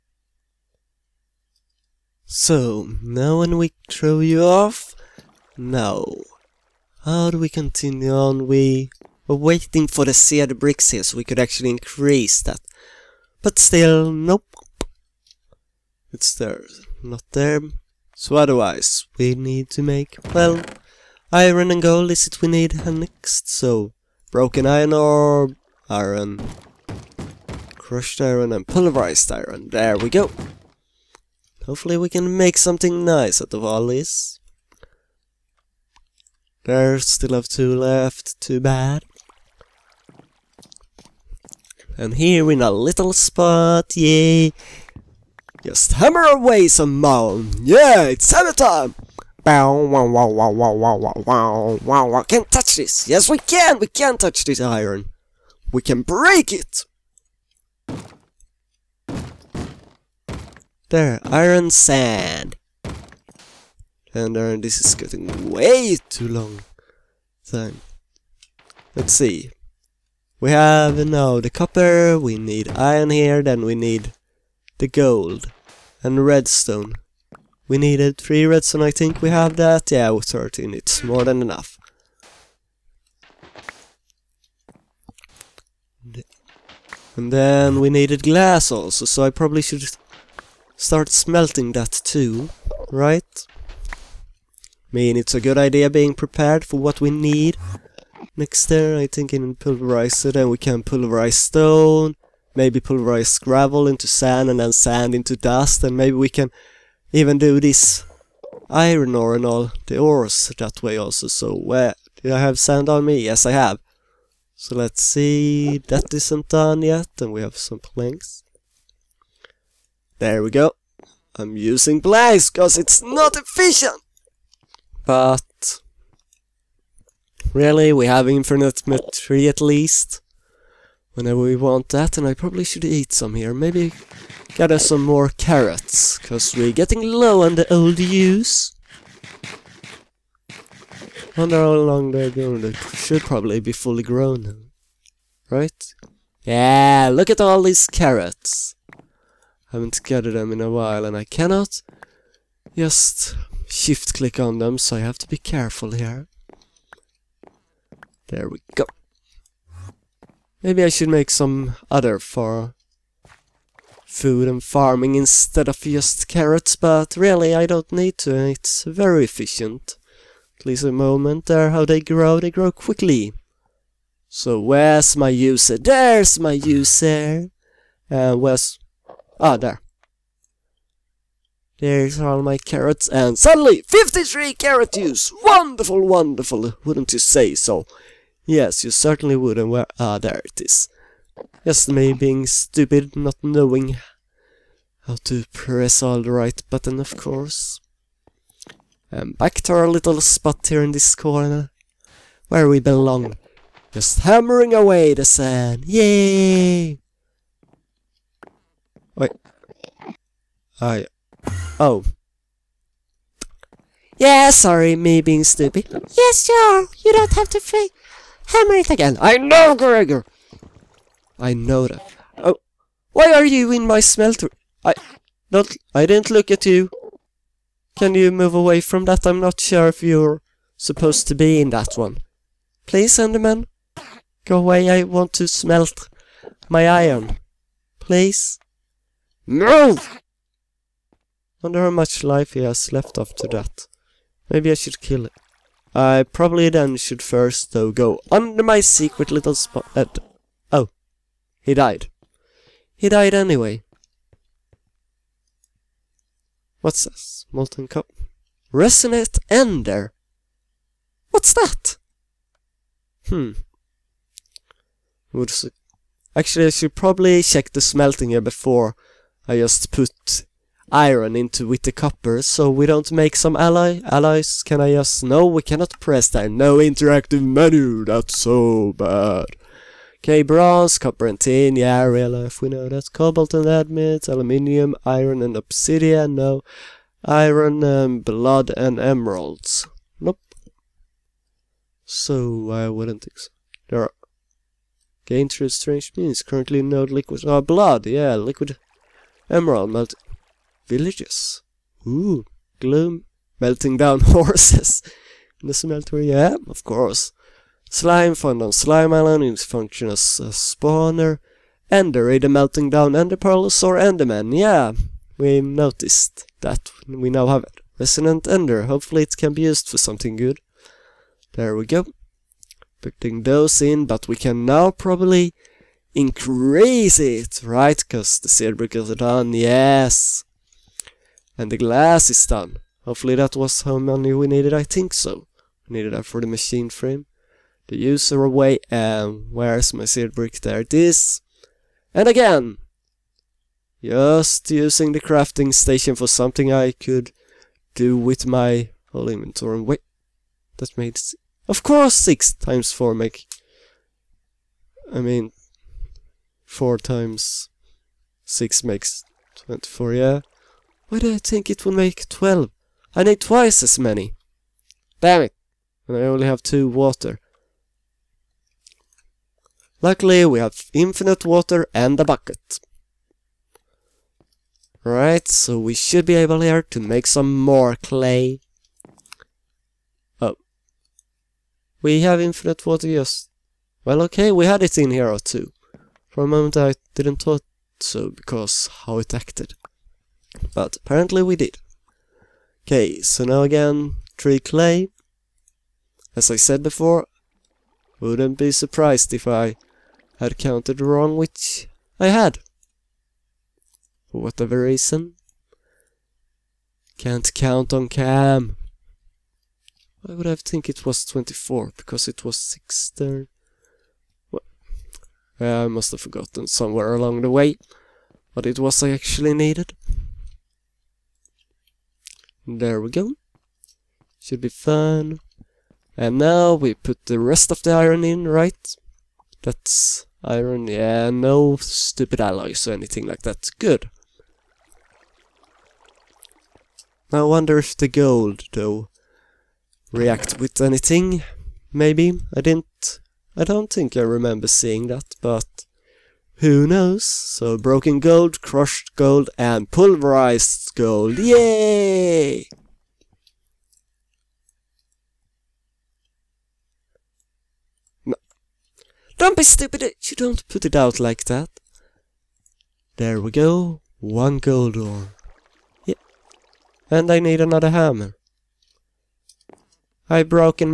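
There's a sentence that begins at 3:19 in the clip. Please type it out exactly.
And back to our little spot here in this corner, where we belong.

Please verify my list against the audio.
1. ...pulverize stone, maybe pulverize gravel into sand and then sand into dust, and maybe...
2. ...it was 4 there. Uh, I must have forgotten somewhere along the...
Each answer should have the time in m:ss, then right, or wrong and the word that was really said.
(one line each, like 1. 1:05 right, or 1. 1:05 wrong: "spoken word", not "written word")
1. 1:40 right
2. 6:52 wrong: "6", not "4".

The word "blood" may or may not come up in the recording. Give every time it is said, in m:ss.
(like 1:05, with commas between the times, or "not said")
4:48, 4:57.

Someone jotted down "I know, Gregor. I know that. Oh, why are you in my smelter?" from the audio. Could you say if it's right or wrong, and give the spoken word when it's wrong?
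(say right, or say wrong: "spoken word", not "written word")
right.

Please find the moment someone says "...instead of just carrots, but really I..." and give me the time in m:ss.
2:45.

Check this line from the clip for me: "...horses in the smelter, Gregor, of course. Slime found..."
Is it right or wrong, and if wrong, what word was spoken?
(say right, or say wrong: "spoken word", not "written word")
wrong: "Yeah", not "Gregor".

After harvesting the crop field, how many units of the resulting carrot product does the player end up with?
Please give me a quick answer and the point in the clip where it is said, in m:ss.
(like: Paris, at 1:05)
53, at 3:03.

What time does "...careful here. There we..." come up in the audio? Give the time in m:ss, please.
2:35.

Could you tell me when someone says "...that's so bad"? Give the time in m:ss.
4:38.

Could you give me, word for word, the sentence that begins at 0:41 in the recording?
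And here in a little spot, yay!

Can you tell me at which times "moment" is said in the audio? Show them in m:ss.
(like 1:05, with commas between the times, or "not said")
2:50, 6:26.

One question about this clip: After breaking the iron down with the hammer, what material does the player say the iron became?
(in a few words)
Iron sand.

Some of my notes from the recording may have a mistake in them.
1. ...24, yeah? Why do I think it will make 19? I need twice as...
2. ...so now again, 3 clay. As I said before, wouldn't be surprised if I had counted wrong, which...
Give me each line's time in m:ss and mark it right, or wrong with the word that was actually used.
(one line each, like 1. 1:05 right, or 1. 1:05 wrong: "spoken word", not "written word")
1. 5:59 wrong: "12", not "19"
2. 6:33 right.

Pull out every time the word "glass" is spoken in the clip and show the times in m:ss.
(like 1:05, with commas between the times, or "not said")
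1:28, 5:31.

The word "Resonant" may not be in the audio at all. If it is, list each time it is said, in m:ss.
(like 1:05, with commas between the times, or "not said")
4:18, 5:17.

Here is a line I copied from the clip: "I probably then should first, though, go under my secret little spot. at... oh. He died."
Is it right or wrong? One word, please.
right.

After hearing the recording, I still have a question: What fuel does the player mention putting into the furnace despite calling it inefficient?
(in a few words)
Blaze.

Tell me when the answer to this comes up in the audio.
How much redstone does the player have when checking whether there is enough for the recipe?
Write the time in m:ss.
1:20.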